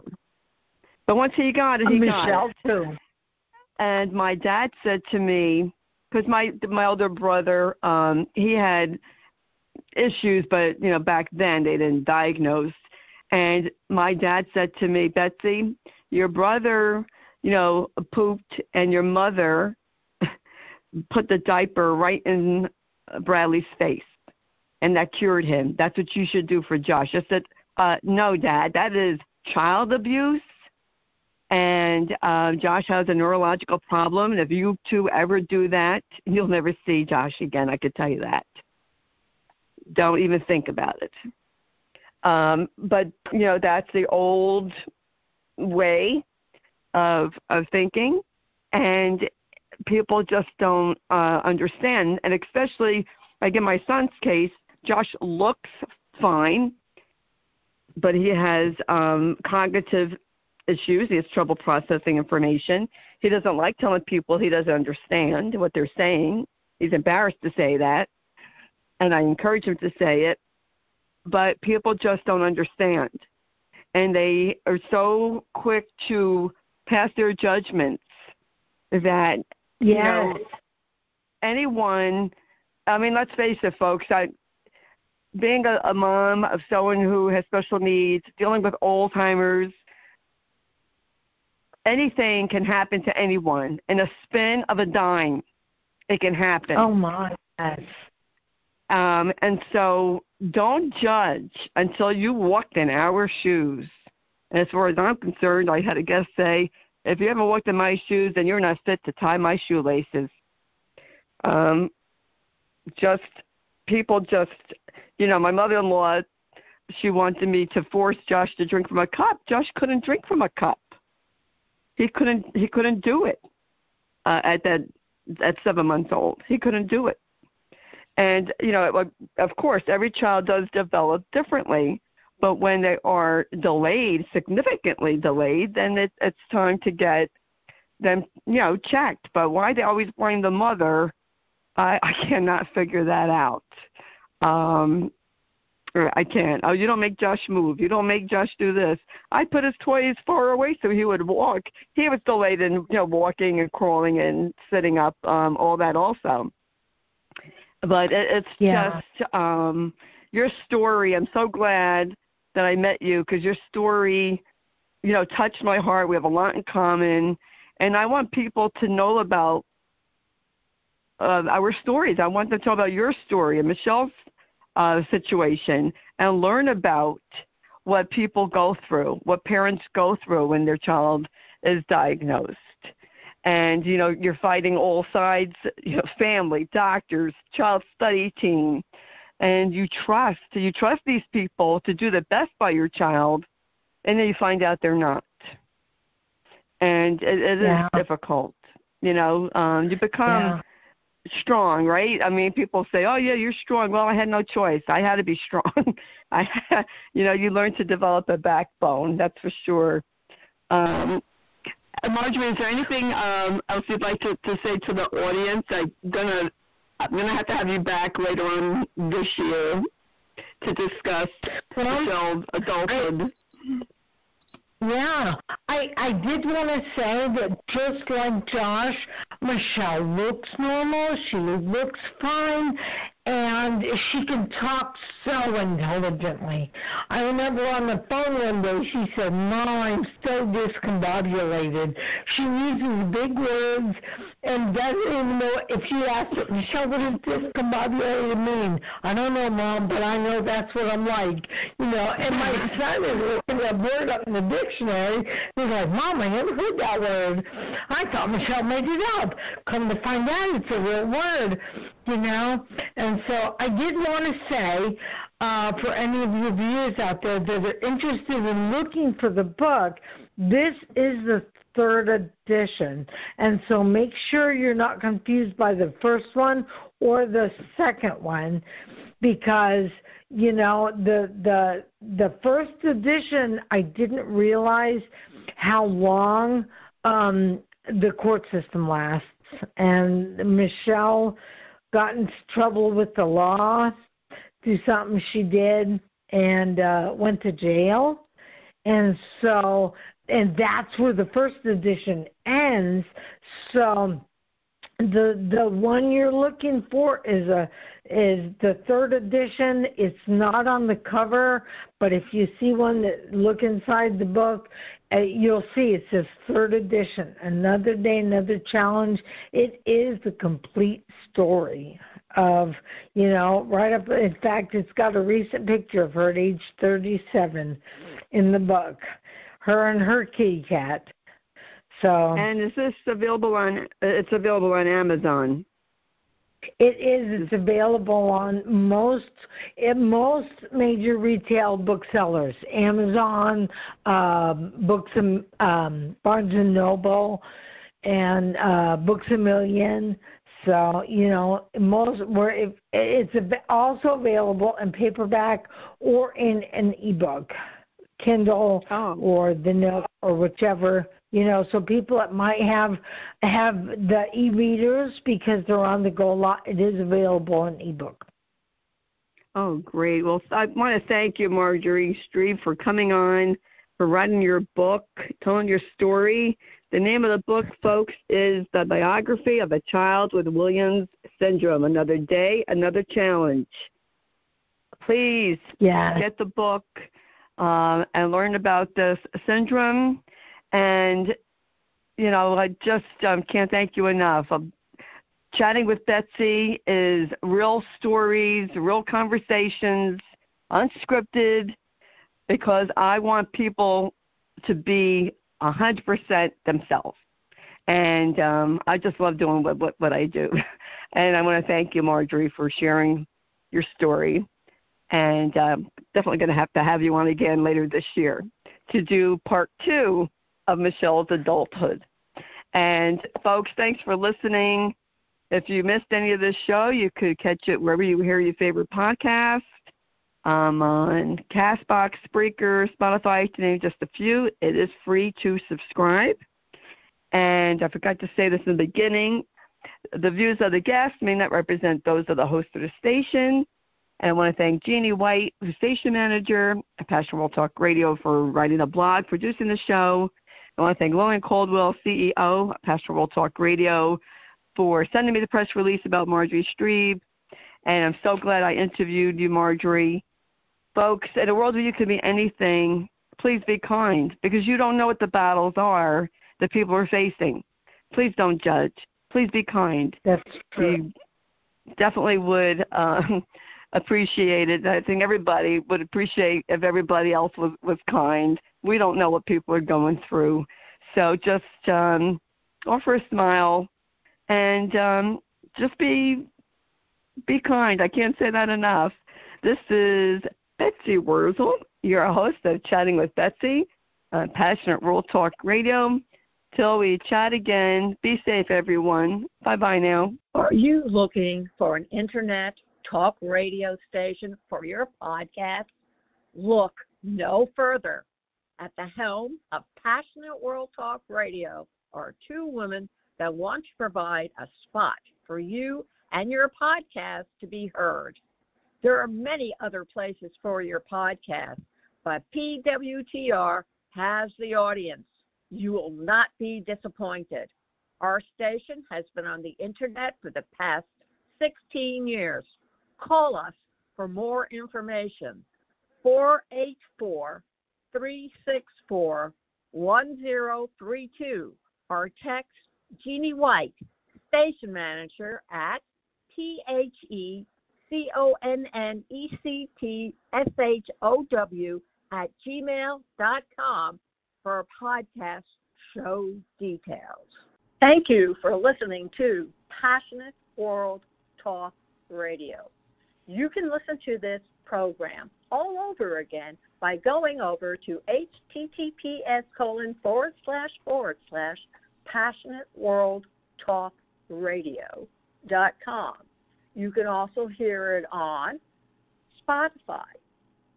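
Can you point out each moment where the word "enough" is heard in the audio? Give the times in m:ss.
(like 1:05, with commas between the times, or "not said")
6:34, 8:08.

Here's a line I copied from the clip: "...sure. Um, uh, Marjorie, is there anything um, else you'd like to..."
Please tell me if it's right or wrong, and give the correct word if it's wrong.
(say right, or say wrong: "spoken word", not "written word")
right.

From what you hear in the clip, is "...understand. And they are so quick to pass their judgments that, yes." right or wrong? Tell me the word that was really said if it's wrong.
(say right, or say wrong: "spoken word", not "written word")
right.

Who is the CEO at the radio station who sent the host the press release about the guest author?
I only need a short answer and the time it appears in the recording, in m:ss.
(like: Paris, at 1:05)
Lauren Caldwell, at 7:31.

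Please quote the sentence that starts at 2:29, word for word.
I put his toys far away so he would walk.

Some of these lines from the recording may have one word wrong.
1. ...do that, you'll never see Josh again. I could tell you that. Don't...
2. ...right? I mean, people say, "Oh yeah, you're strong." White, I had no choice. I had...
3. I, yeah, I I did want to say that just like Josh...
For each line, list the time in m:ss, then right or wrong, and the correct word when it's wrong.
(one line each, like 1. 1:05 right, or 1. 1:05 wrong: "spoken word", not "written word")
1. 0:35 right
2. 3:21 wrong: "Well", not "White"
3. 3:43 right.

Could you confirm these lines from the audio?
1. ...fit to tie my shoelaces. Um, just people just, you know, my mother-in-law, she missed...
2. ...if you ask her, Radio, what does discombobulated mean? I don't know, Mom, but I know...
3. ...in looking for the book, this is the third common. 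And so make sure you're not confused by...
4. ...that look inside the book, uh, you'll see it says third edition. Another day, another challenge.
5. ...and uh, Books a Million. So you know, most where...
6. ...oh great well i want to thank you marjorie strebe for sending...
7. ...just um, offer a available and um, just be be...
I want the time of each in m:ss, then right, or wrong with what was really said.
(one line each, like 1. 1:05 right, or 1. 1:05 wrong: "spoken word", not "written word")
1. 1:48 wrong: "wanted", not "missed"
2. 4:05 wrong: "Michelle", not "Radio"
3. 4:28 wrong: "edition", not "common"
4. 5:13 right
5. 5:48 right
6. 6:09 wrong: "coming", not "sending"
7. 8:01 wrong: "smile", not "available".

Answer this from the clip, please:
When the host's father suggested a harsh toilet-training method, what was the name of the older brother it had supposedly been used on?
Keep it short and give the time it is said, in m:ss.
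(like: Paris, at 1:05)
Bradley, at 0:23.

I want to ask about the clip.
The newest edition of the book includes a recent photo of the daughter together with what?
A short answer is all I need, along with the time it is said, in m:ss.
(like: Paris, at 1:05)
Her kitty cat, at 5:30.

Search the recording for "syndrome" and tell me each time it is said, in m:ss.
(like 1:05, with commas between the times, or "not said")
6:21, 6:29.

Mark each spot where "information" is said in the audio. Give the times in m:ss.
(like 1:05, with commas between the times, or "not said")
1:02, 8:54.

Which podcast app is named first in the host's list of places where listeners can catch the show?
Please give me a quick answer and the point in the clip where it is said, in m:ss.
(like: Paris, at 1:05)
Castbox, at 7:11.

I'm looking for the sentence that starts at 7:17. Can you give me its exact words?
And I forgot to say this in the beginning.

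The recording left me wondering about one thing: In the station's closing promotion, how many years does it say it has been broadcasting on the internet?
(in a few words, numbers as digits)
16 years.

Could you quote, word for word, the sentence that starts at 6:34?
Um, chatting with Betsy is real stories, real conversations, unscripted, because I want people to be 100% themselves.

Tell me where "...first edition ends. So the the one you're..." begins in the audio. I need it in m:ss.
5:01.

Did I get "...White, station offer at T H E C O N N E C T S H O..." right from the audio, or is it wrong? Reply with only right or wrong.
wrong.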